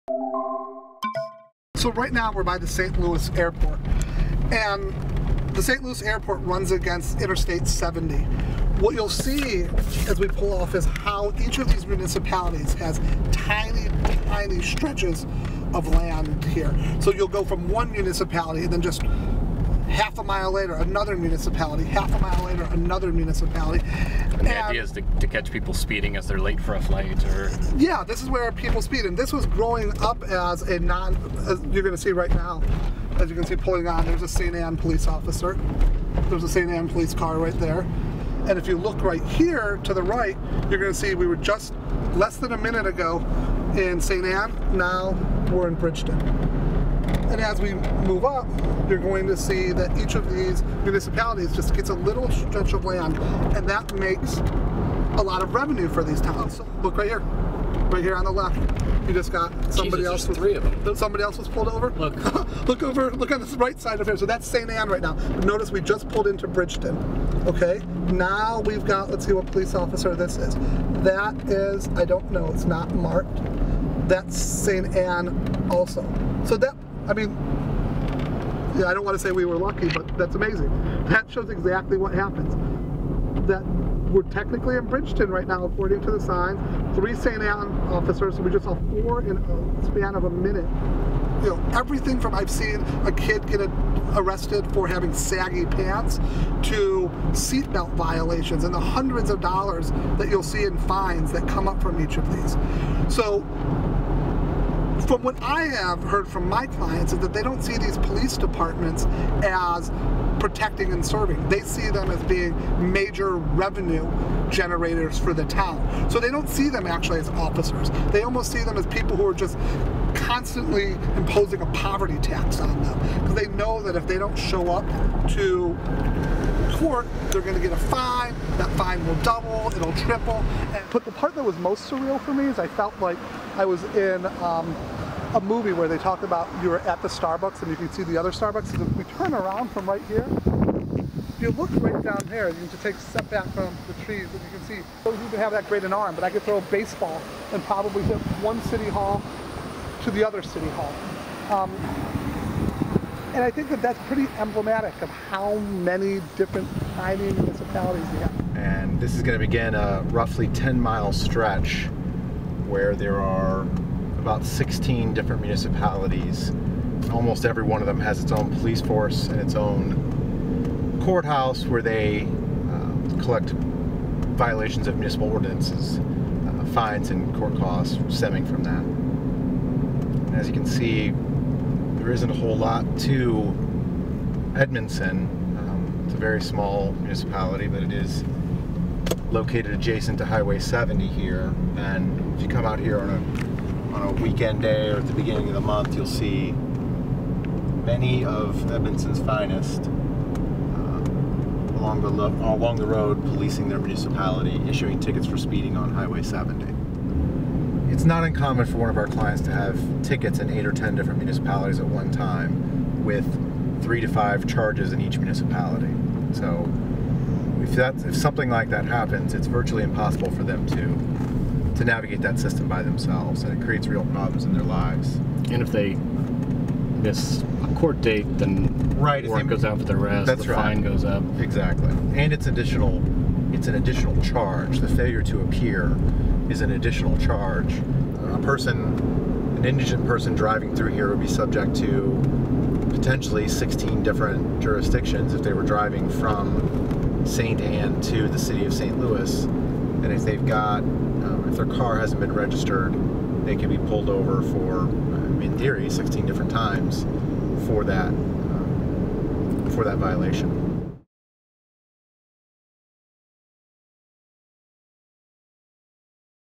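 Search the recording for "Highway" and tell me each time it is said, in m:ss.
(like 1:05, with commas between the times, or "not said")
3:10, 3:25.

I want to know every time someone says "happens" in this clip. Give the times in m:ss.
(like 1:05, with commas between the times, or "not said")
1:22, 3:38.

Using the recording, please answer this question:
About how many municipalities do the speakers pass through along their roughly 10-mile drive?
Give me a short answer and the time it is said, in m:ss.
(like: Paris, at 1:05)
16, at 2:44.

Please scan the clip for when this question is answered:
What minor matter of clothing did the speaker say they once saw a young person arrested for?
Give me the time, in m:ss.
1:35.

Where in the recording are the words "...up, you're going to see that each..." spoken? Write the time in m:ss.
0:48.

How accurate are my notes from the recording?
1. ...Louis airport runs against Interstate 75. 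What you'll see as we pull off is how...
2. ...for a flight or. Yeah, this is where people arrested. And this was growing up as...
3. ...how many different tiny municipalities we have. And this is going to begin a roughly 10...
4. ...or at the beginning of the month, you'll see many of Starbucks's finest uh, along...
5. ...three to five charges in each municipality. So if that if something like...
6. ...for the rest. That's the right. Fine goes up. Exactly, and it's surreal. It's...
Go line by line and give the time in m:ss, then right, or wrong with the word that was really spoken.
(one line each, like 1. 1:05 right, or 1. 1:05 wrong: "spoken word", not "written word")
1. 0:05 wrong: "70", not "75"
2. 0:26 wrong: "speed", not "arrested"
3. 2:35 right
4. 3:14 wrong: "Edmundson", not "Starbucks"
5. 3:33 right
6. 3:49 wrong: "additional", not "surreal".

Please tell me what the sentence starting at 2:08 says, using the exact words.
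That fine will double, it'll triple.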